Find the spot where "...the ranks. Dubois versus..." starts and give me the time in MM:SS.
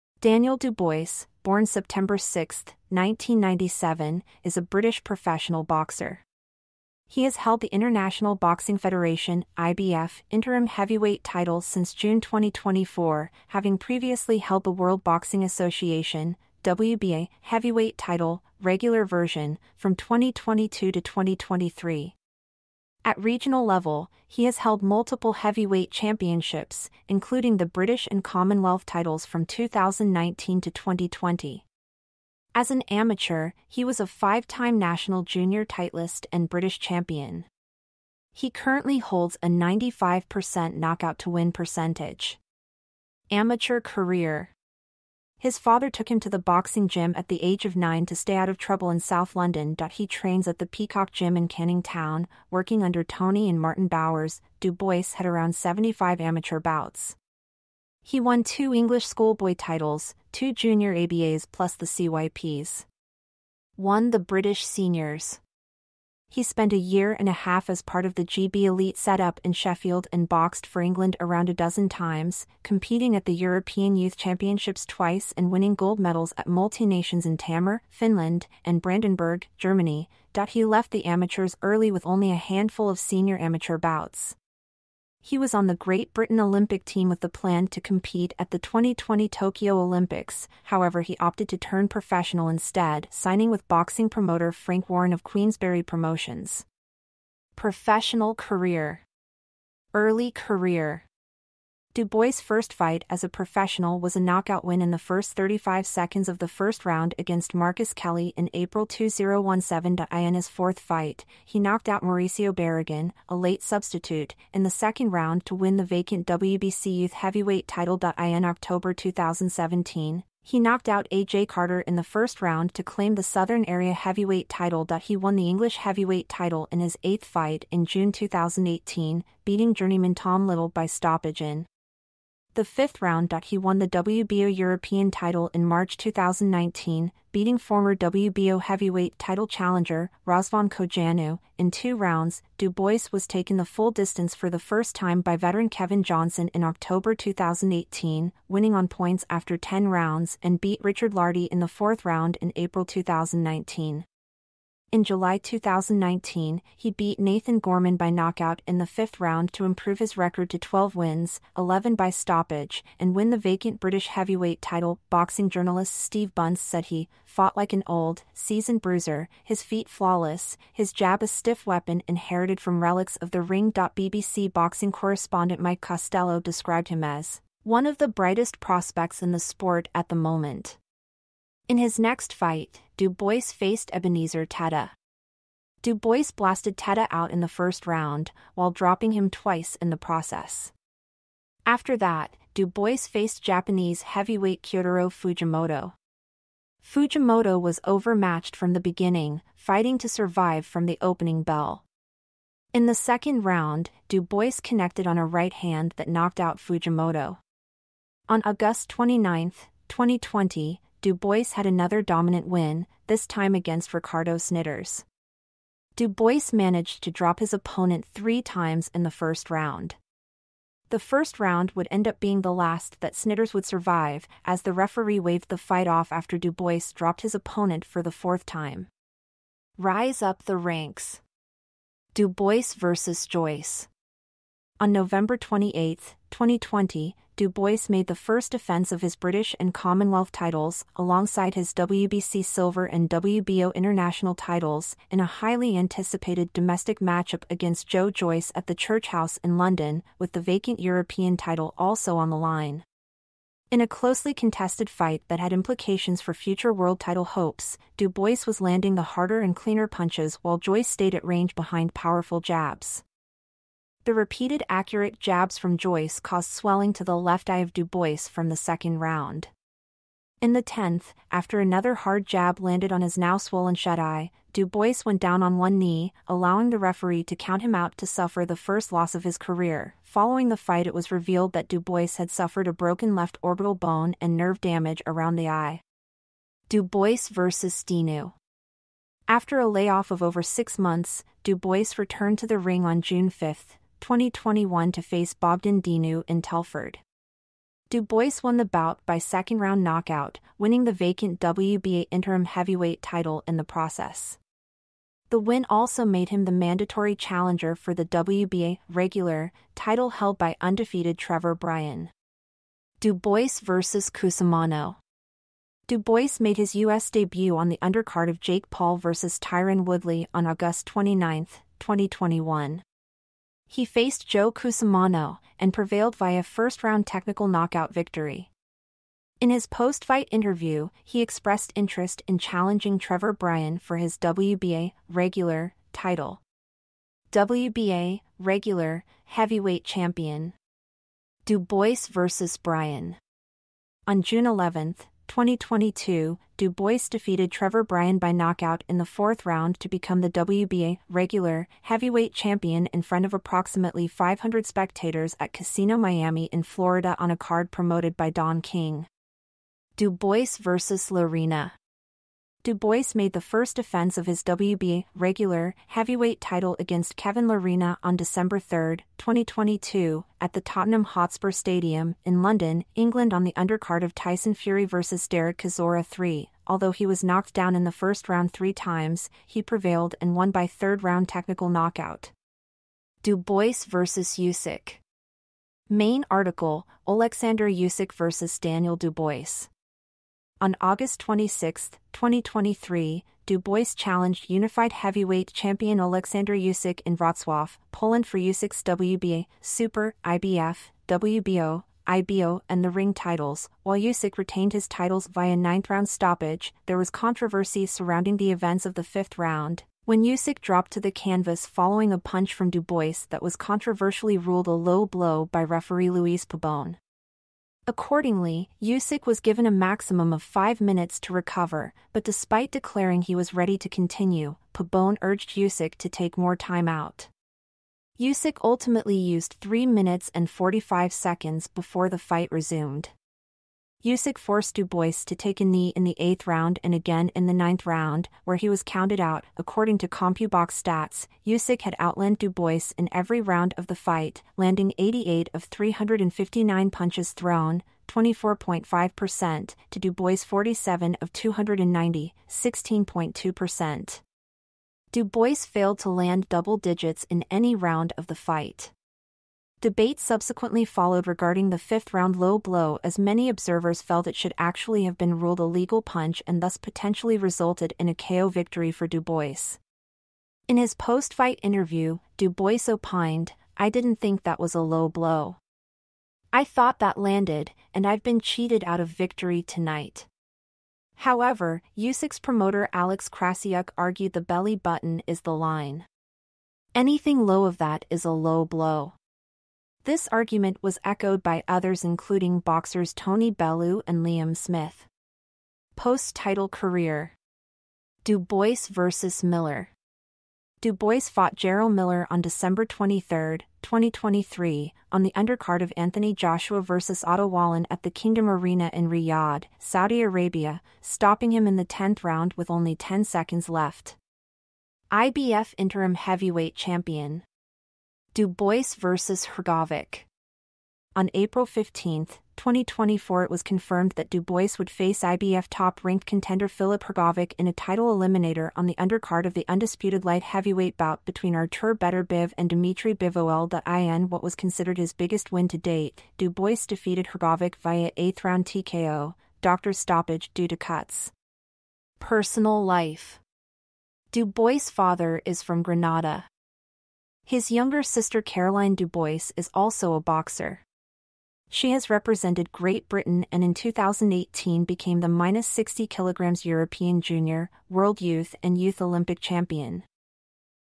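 03:50.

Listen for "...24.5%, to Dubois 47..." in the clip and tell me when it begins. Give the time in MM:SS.
07:28.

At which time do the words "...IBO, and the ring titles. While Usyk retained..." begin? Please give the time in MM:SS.
06:42.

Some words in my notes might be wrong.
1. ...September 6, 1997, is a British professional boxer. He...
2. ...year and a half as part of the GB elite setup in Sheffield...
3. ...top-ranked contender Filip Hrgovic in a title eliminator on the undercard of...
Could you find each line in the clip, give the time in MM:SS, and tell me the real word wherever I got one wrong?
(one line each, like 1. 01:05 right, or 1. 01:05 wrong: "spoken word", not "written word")
1. 00:01 right
2. 01:06 right
3. 08:45 right.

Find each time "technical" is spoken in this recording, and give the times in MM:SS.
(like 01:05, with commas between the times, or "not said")
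05:27, 06:21.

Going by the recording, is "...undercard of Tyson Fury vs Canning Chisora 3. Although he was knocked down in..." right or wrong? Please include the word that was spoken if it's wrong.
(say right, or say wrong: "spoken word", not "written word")
wrong: "Derek", not "Canning".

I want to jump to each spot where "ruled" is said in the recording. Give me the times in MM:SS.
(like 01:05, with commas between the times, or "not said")
06:54, 07:45.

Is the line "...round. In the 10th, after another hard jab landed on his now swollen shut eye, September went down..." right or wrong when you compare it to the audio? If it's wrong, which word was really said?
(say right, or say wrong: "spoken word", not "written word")
wrong: "Dubois", not "September".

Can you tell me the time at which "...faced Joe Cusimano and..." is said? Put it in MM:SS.
05:23.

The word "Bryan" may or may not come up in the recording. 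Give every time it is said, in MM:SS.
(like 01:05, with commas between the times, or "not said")
05:11, 05:33, 05:42, 05:47.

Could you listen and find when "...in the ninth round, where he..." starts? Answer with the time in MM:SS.
07:17.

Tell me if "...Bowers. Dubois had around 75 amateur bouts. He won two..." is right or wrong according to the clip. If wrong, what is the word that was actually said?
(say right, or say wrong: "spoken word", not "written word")
right.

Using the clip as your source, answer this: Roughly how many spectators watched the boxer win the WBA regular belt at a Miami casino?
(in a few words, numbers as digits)
500.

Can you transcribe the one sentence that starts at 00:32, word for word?
As an amateur, he was a five-time national junior titlist and British champion.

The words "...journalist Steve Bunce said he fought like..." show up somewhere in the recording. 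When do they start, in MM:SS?
02:45.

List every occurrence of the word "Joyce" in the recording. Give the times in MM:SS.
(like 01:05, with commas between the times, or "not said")
03:53, 04:08, 04:20, 04:25.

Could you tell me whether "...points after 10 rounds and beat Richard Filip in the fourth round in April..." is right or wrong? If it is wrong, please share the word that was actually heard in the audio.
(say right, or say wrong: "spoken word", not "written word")
wrong: "Lartey", not "Filip".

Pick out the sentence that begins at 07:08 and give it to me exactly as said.
Usyk ultimately used 3 minutes and 45 seconds before the fight resumed.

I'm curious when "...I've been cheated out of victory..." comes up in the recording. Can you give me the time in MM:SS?
07:58.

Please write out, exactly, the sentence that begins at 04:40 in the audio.
Following the fight, it was revealed that Dubois had suffered a broken left orbital bone and nerve damage around the eye.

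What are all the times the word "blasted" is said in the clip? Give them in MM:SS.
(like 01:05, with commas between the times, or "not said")
03:06.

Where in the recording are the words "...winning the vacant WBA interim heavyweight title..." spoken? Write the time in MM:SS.
05:00.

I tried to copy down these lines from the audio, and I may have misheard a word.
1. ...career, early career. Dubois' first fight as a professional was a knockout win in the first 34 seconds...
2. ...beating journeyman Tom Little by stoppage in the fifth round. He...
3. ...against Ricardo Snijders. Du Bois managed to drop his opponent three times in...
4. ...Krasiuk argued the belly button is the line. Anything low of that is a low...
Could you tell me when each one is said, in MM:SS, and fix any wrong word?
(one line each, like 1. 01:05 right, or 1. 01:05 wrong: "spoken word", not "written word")
1. 01:38 wrong: "35", not "34"
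2. 02:09 right
3. 03:33 right
4. 08:03 right.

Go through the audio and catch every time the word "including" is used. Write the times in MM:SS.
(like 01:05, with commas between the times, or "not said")
00:27, 08:12.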